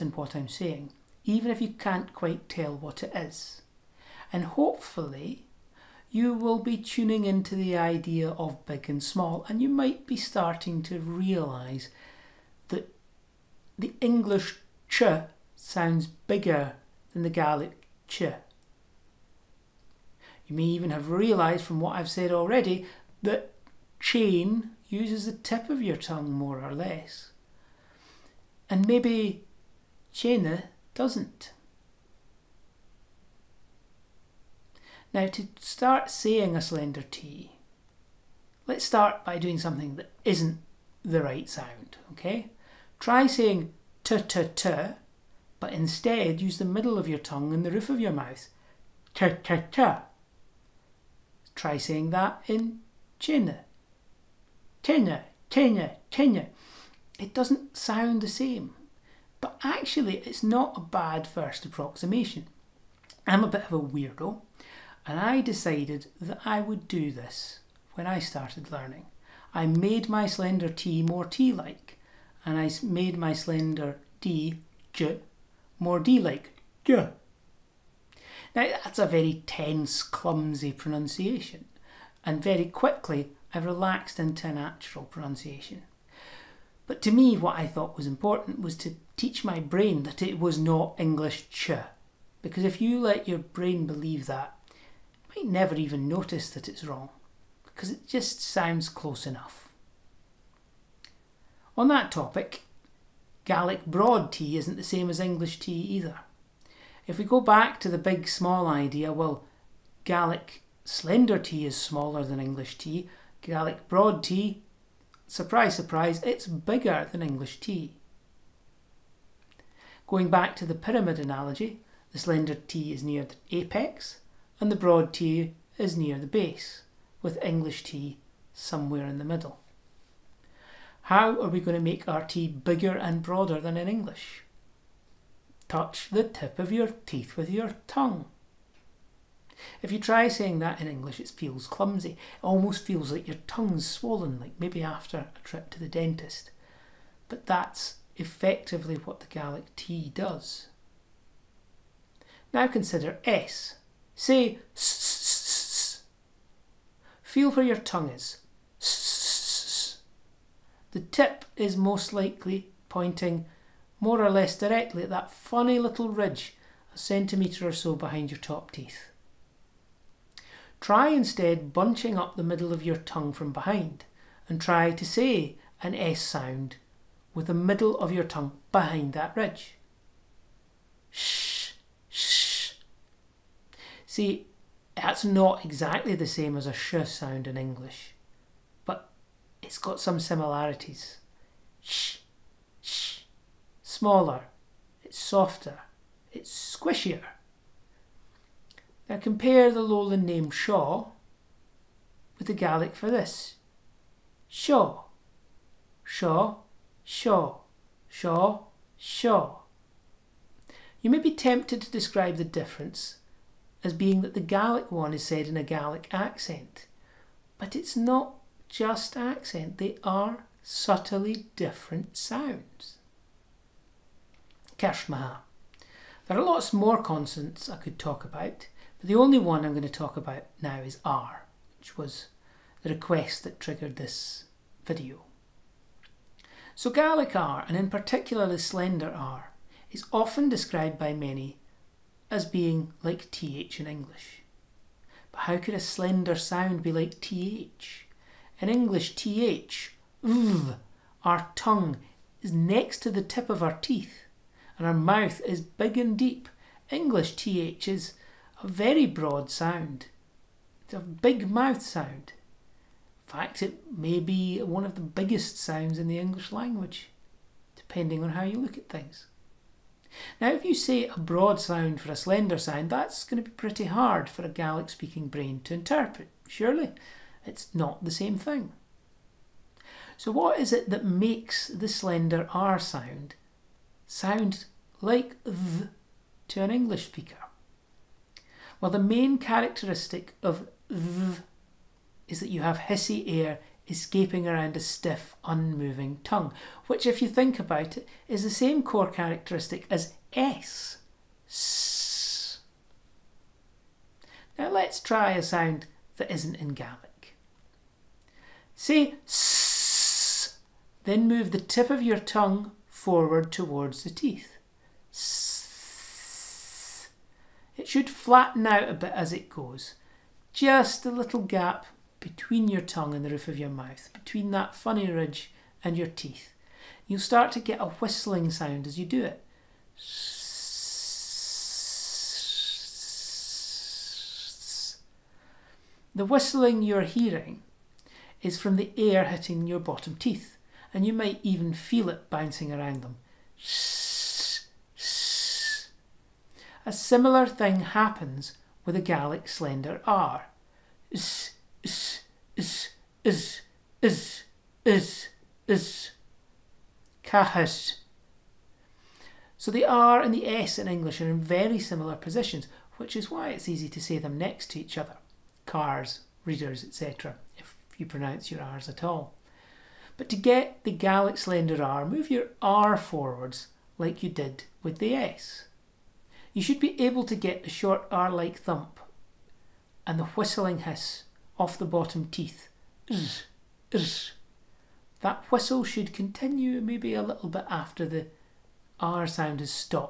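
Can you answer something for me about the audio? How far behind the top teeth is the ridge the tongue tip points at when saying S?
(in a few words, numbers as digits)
A centimetre or so.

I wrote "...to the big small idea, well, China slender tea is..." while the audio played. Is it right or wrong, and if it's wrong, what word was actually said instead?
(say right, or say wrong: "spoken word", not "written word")
wrong: "Gaelic", not "China".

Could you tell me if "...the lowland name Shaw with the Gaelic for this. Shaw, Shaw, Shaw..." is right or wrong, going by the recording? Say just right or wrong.
right.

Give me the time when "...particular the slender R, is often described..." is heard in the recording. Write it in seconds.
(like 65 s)
237 s.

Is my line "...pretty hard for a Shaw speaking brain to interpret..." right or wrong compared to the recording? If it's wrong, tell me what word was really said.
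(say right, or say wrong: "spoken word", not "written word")
wrong: "Gaelic", not "Shaw".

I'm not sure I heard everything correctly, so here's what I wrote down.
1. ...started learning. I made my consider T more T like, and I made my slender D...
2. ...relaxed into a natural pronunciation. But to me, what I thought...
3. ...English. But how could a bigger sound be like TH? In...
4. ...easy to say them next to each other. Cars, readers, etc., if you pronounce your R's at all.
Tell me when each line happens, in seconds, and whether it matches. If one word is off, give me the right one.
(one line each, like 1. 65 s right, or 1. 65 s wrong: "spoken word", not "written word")
1. 68 s wrong: "slender", not "consider"
2. 83 s right
3. 243 s wrong: "slender", not "bigger"
4. 363 s right.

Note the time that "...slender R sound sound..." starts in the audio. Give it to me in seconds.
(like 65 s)
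281 s.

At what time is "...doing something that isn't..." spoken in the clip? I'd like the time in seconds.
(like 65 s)
39 s.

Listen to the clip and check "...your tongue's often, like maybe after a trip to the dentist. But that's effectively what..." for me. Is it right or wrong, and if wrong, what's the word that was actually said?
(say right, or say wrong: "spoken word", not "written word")
wrong: "swollen", not "often".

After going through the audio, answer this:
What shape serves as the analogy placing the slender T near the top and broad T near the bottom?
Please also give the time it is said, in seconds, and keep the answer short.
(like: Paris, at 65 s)
Pyramid, at 120 s.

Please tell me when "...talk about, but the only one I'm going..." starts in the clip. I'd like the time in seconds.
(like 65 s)
227 s.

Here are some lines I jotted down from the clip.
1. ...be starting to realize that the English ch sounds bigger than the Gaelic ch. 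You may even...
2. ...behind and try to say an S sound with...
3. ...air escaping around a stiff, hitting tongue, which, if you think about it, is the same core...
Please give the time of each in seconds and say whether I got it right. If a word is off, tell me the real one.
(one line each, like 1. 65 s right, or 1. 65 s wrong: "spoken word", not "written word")
1. 10 s right
2. 173 s right
3. 293 s wrong: "unmoving", not "hitting".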